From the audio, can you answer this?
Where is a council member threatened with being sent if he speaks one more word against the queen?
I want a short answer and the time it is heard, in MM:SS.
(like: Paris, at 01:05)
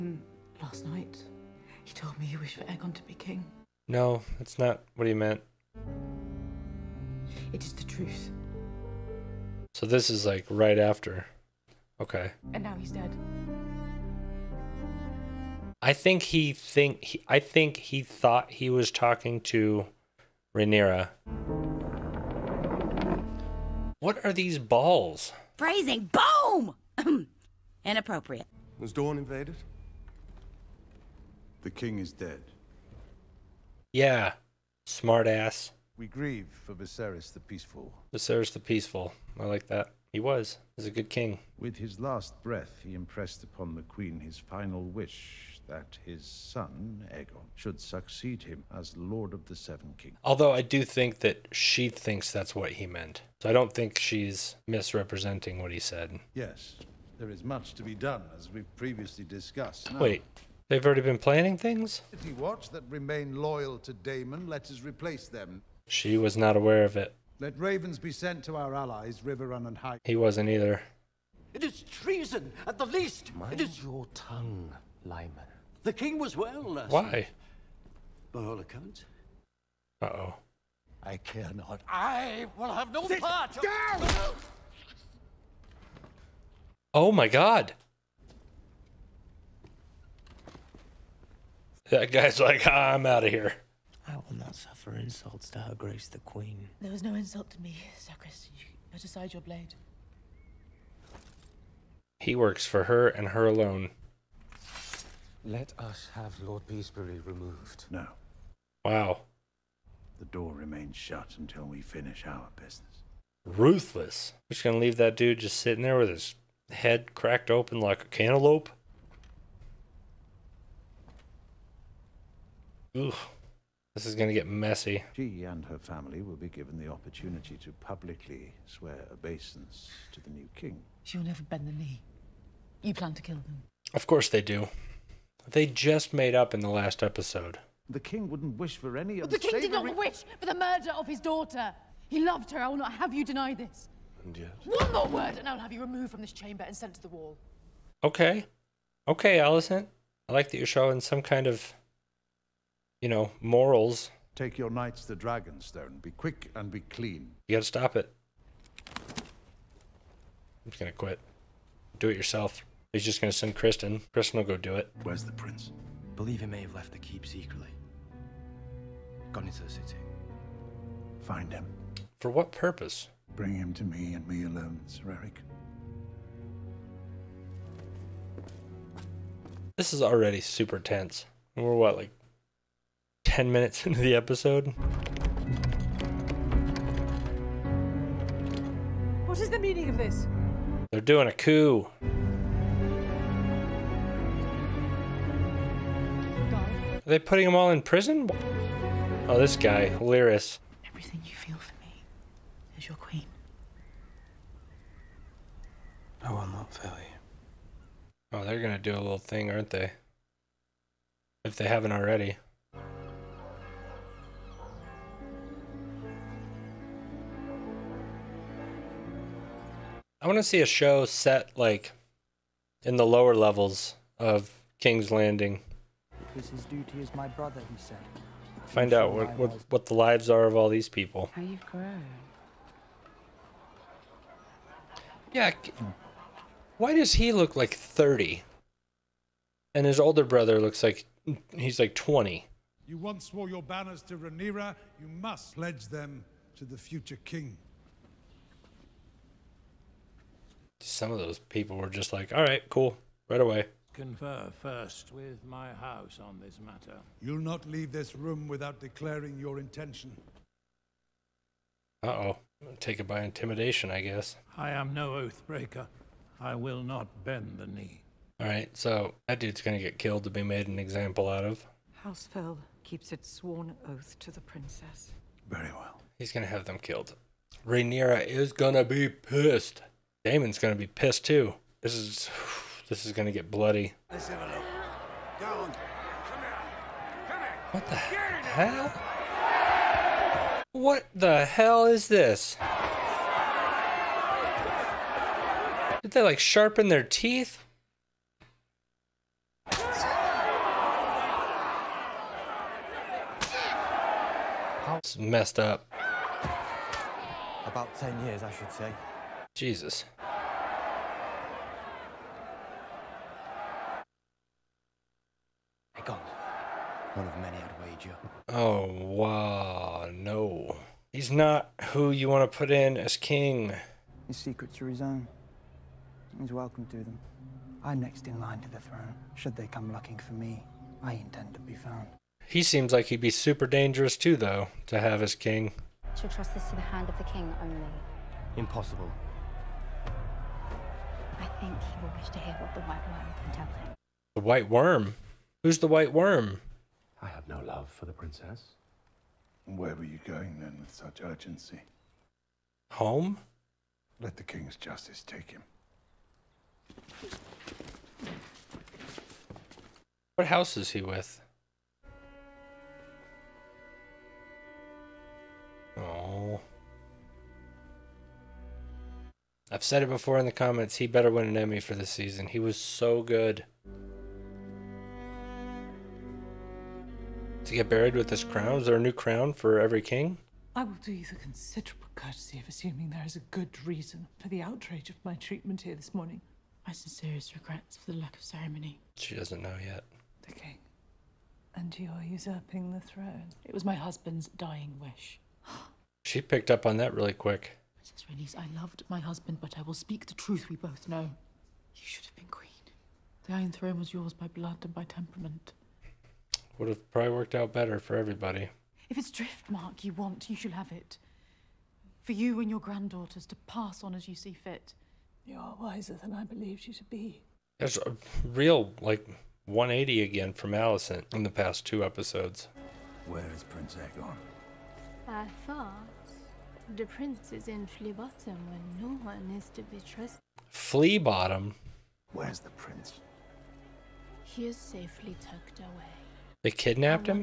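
the Wall, at 02:27.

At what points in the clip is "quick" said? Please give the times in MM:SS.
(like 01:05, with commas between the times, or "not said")
02:36, 06:37.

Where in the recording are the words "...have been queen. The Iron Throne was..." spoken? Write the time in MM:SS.
06:42.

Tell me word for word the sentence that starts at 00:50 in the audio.
Although I do think that she thinks that's what he meant.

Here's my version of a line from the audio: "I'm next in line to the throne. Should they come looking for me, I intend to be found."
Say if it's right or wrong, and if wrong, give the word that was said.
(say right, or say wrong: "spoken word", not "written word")
right.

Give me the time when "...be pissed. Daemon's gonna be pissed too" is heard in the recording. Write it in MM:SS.
04:38.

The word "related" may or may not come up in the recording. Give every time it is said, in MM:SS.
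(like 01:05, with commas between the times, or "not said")
not said.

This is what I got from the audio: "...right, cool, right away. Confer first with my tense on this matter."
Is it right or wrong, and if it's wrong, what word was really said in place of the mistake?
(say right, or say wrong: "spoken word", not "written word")
wrong: "house", not "tense".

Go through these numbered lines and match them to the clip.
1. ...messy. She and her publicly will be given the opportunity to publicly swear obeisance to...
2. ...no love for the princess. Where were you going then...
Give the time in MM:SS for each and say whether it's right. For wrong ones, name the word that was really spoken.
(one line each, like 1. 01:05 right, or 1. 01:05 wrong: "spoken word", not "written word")
1. 02:04 wrong: "family", not "publicly"
2. 05:47 right.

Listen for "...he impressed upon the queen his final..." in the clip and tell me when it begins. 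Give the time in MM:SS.
00:42.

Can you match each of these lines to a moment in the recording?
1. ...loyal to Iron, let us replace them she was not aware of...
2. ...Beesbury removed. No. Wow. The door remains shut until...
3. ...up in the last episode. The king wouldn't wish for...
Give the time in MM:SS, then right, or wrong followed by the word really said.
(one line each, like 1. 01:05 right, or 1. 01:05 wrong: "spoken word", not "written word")
1. 01:03 wrong: "Daemon", not "Iron"
2. 01:46 right
3. 02:16 right.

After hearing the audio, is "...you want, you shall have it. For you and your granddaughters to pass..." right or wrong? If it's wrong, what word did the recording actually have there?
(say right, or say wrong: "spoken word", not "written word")
right.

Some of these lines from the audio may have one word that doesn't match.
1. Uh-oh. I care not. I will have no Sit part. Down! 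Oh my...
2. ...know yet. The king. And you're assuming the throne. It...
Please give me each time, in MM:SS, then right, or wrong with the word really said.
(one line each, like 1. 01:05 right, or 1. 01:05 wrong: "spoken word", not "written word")
1. 01:20 right
2. 06:29 wrong: "usurping", not "assuming".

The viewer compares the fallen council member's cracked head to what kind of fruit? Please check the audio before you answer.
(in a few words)
cantaloupe.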